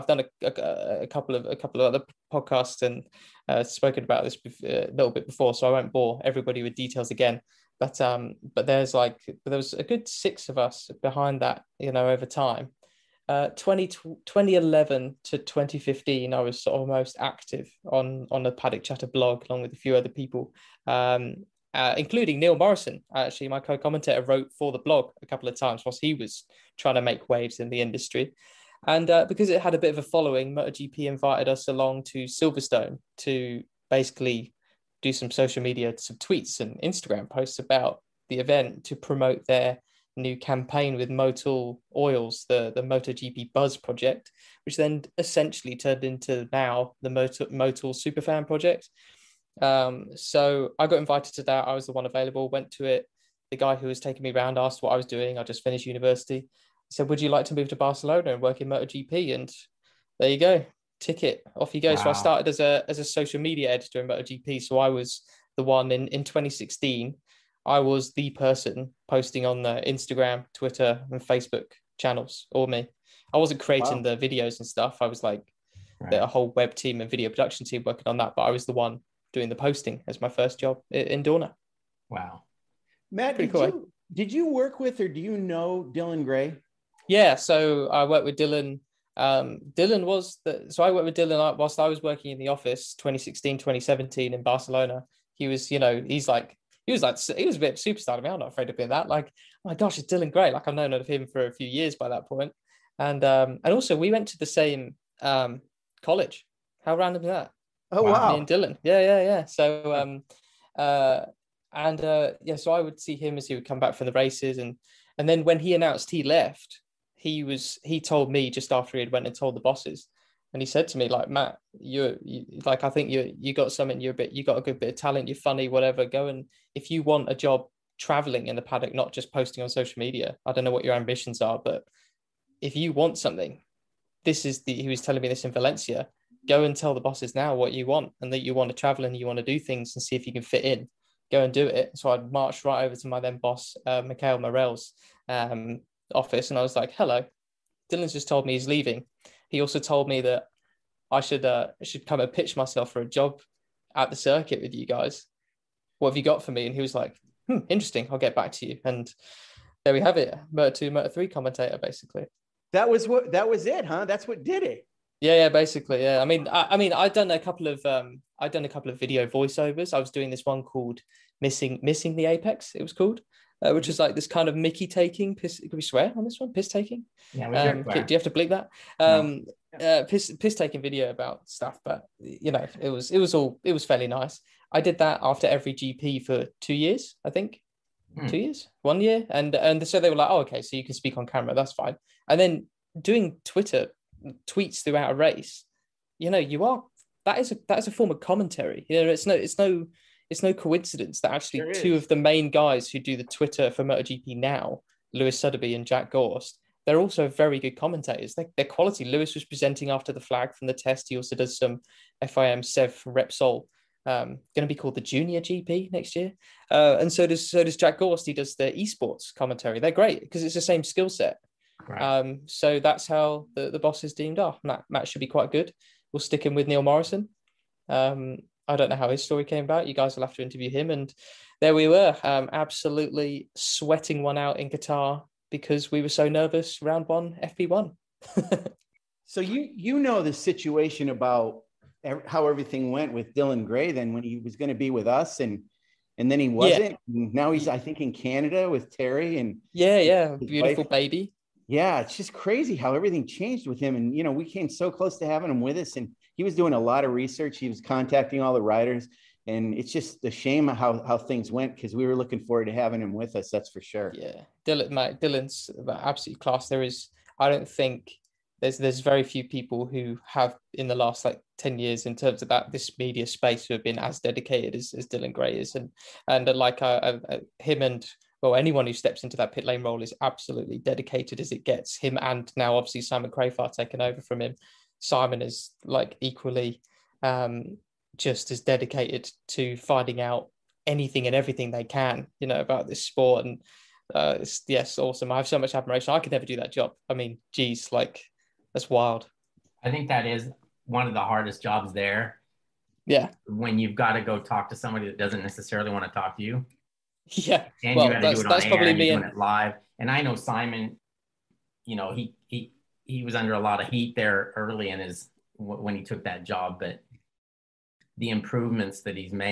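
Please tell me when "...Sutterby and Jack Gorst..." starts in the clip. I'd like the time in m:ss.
3:25.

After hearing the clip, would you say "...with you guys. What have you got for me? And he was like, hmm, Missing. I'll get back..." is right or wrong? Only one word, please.
wrong.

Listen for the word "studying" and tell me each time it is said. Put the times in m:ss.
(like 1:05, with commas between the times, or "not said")
not said.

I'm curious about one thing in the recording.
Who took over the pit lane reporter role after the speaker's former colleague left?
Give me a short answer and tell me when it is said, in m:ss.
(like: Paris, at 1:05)
Simon Crafar, at 4:43.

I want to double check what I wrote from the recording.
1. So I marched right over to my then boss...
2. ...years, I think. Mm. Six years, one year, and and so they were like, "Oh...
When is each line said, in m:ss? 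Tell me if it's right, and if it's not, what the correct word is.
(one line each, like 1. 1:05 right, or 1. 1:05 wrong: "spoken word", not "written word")
1. 2:21 right
2. 3:06 wrong: "Two", not "Six".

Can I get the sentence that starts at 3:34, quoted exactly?
Um, going to be called the Junior GP next year, uh, and so does so does Jack Gorst.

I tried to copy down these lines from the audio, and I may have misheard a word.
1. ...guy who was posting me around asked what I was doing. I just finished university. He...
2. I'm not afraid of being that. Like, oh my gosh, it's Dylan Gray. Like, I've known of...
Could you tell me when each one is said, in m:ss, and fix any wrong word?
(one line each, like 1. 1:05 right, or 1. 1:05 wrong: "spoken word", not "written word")
1. 0:53 wrong: "taking", not "posting"
2. 1:38 right.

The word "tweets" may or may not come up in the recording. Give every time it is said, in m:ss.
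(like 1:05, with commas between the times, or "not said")
0:36, 3:14.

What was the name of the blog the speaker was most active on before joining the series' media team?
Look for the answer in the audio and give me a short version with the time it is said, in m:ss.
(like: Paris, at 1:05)
Paddock Chatter, at 0:18.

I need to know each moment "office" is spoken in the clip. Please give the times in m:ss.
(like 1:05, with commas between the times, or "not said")
1:32, 2:26.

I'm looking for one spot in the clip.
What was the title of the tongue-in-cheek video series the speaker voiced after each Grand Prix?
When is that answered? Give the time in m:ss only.
2:51.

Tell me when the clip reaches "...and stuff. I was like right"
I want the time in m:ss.
1:14.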